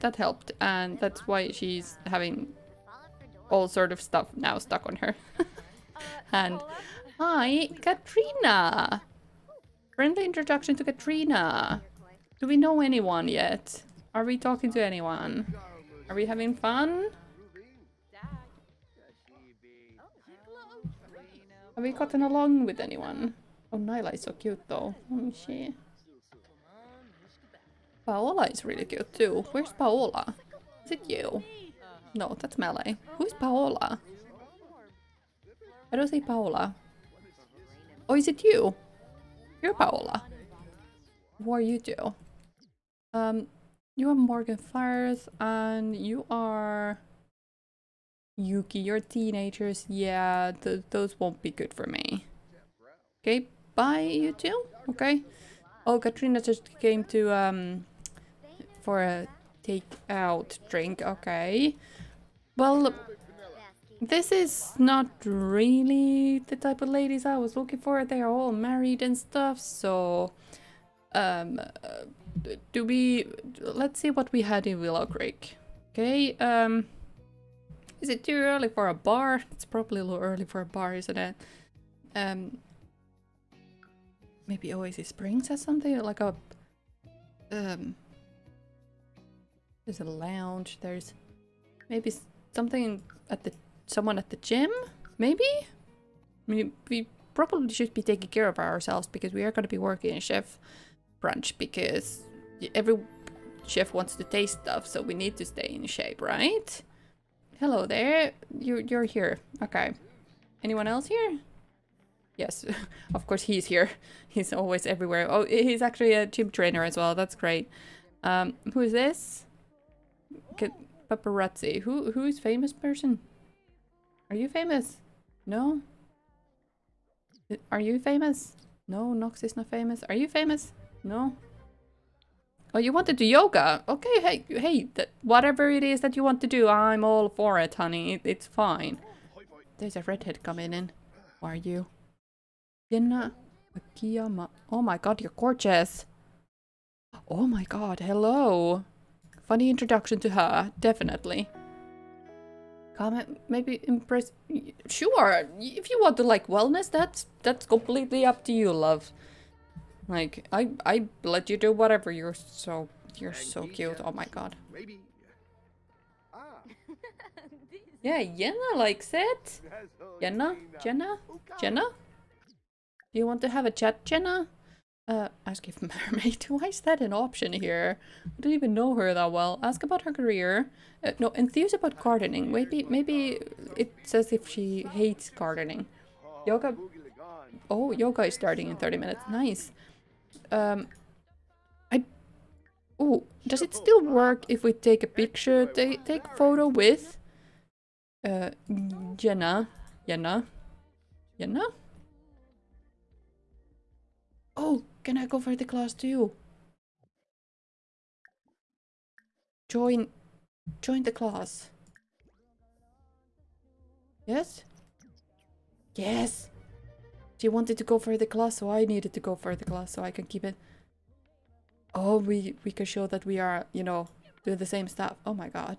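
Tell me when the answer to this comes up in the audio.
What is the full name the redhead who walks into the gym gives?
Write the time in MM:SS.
02:22.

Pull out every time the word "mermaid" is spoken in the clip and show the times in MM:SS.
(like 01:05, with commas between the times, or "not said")
02:55.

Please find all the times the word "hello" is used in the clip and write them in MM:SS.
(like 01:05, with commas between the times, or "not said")
01:47, 02:28.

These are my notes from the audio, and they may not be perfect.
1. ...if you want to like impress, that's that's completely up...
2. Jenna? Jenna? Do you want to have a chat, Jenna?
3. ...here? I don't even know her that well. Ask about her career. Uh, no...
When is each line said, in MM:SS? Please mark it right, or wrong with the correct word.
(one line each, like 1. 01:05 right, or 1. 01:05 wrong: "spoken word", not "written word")
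1. 02:35 wrong: "wellness", not "impress"
2. 02:50 right
3. 02:57 right.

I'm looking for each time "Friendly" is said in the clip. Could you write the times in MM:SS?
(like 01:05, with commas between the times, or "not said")
00:09.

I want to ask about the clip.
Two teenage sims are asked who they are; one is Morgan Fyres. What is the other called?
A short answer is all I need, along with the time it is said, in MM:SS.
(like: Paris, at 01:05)
Yuki, at 00:48.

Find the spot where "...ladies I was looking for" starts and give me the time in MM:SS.
01:06.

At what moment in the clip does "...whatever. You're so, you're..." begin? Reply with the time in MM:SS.
02:41.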